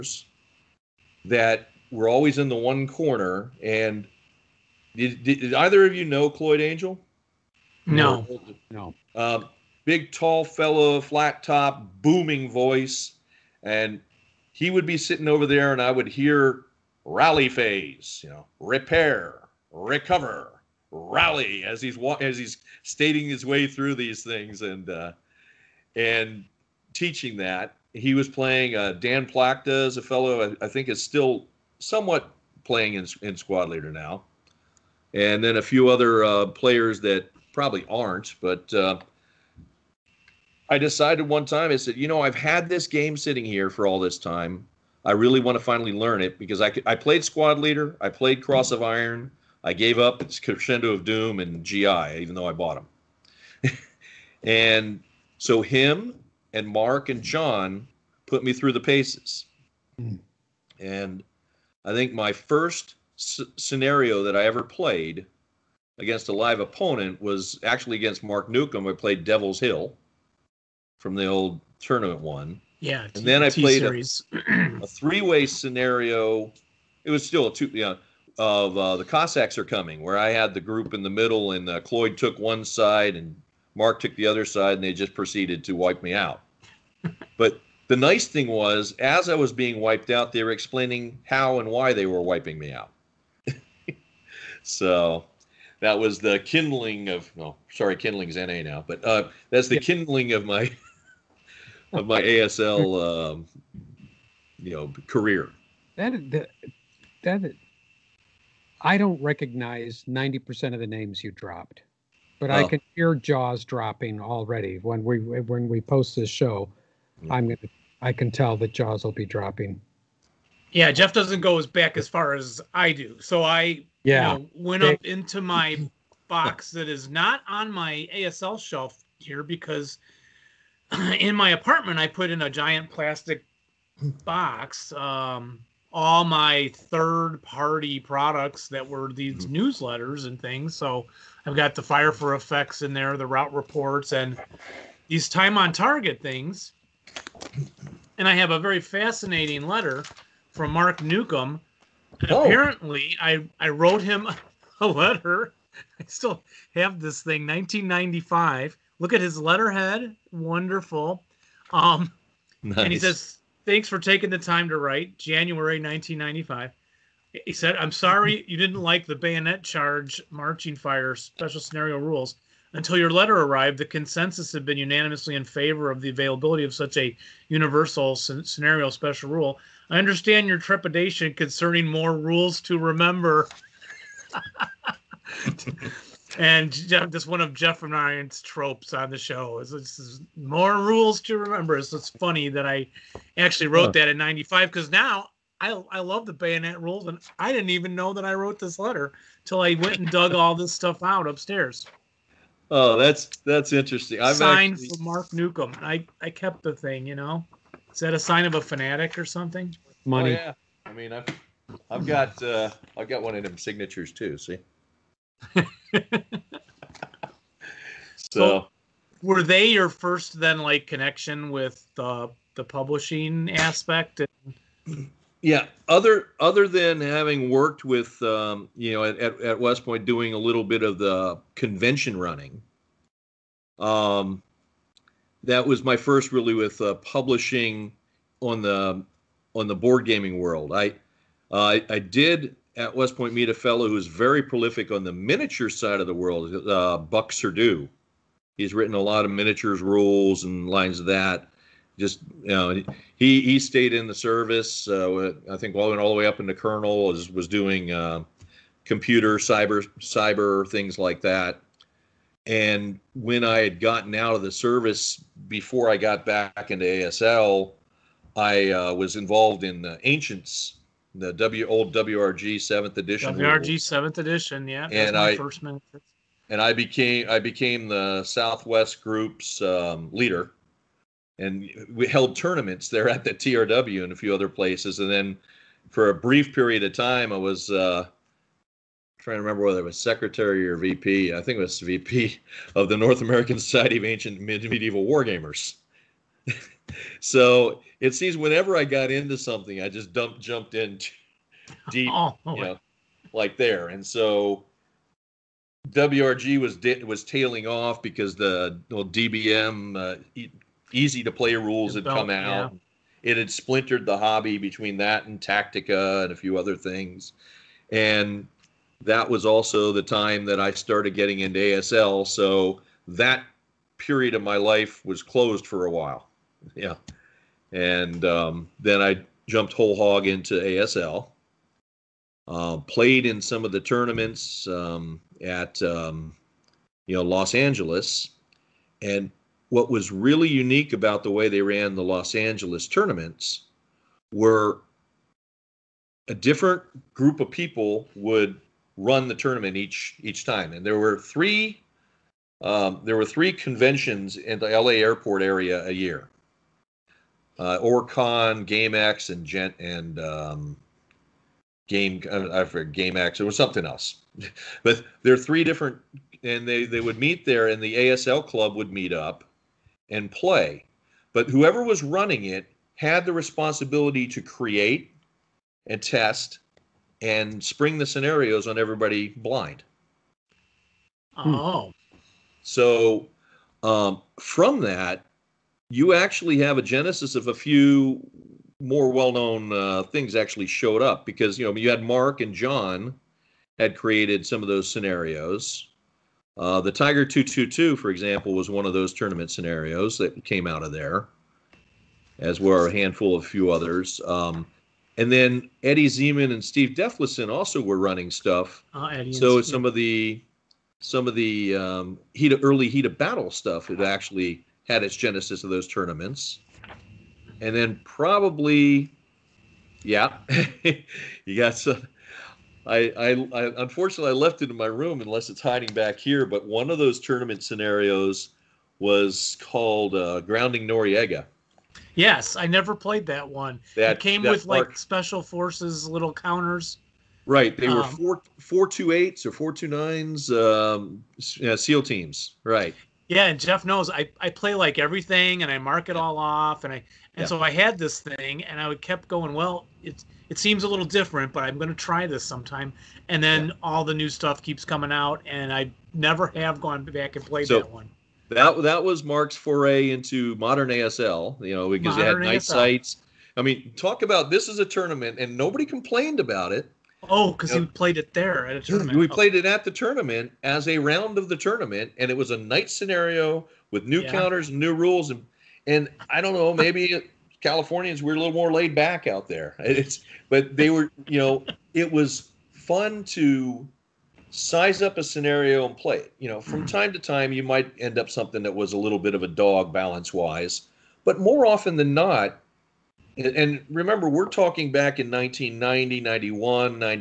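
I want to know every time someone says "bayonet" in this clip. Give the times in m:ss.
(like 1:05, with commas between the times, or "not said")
2:49, 3:16.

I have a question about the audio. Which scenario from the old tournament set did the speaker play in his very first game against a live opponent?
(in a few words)
Devil's Hill.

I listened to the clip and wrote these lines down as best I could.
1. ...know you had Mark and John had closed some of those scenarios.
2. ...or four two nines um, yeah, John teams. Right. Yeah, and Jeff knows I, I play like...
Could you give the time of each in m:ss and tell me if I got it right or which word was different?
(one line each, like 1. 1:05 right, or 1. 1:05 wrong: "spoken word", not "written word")
1. 6:31 wrong: "created", not "closed"
2. 7:19 wrong: "SEAL", not "John".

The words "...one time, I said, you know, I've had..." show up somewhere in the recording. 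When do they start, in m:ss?
0:41.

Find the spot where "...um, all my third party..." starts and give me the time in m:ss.
2:14.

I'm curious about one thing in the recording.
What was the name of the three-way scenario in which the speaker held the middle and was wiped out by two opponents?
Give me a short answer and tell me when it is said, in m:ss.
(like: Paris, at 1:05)
The Cossacks are coming, at 1:18.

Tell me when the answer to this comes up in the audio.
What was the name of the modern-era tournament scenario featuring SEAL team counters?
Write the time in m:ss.
7:10.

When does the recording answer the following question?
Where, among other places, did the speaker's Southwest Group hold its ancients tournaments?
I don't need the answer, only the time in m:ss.
4:43.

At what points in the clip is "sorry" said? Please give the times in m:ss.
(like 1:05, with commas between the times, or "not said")
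1:37, 2:47.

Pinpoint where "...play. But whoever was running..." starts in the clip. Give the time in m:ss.
6:10.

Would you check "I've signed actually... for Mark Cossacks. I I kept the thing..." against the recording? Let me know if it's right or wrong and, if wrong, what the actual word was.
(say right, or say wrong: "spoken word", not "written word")
wrong: "Neukom", not "Cossacks".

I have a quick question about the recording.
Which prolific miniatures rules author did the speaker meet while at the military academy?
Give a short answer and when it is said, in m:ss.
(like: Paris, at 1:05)
Buck Surdu, at 4:06.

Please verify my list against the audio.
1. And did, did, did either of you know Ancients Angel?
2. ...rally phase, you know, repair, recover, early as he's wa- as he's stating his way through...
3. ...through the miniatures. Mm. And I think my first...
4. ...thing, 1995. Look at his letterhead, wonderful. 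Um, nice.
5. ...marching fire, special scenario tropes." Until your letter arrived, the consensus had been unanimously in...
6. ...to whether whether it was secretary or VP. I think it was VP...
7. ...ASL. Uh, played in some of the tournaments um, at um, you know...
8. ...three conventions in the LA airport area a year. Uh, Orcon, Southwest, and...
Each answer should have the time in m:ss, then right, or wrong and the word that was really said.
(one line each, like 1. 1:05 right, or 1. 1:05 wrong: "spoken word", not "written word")
1. 0:03 wrong: "Cloyd", not "Ancients"
2. 0:17 wrong: "rally", not "early"
3. 0:58 wrong: "paces", not "miniatures"
4. 2:37 right
5. 2:50 wrong: "rules", not "tropes"
6. 4:49 wrong: "remember", not "whether"
7. 5:30 right
8. 5:53 wrong: "GameX", not "Southwest".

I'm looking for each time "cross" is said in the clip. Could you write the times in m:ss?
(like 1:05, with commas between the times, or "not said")
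0:48.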